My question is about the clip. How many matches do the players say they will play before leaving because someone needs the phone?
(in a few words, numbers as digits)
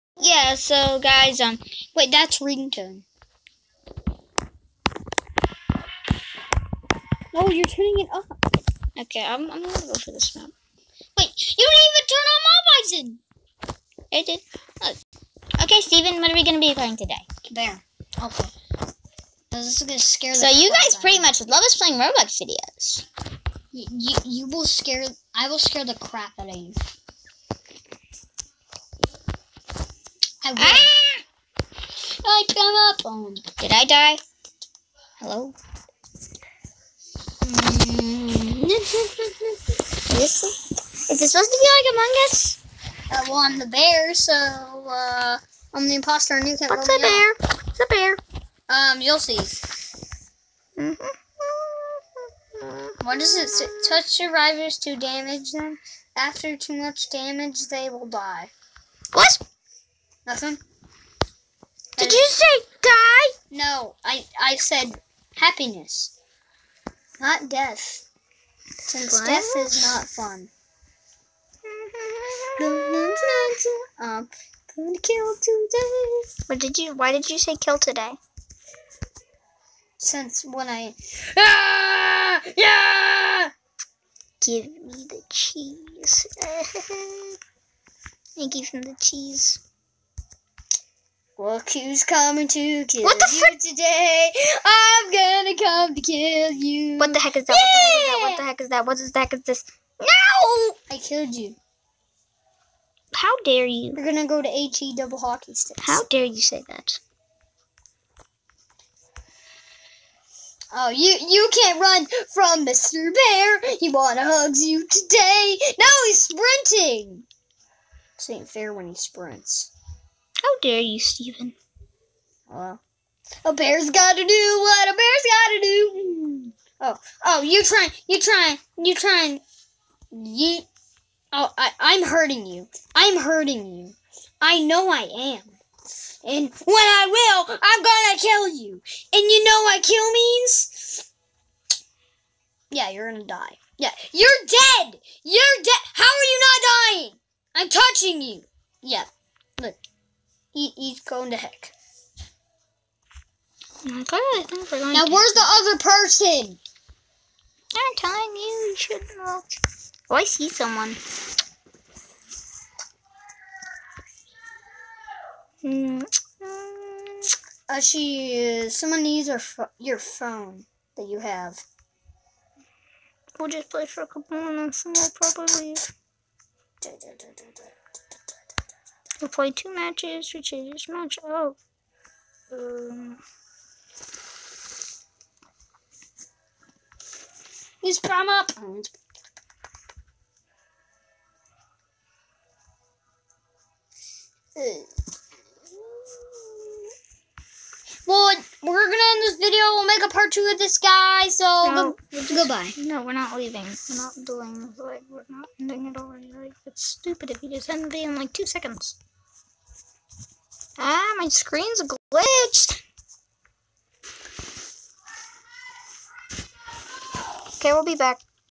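2.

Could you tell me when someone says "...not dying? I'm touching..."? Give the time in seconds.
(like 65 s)
146 s.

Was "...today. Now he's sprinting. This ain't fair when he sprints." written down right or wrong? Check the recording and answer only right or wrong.
right.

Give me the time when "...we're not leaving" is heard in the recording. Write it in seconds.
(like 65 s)
203 s.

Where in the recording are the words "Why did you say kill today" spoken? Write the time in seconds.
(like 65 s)
76 s.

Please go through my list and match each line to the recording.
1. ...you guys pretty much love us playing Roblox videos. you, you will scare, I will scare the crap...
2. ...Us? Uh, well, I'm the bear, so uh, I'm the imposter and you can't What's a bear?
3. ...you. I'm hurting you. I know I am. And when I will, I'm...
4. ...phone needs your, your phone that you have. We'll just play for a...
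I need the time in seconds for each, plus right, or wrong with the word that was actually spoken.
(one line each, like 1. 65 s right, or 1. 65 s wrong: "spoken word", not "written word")
1. 20 s right
2. 42 s right
3. 132 s right
4. 168 s wrong: "someone", not "phone".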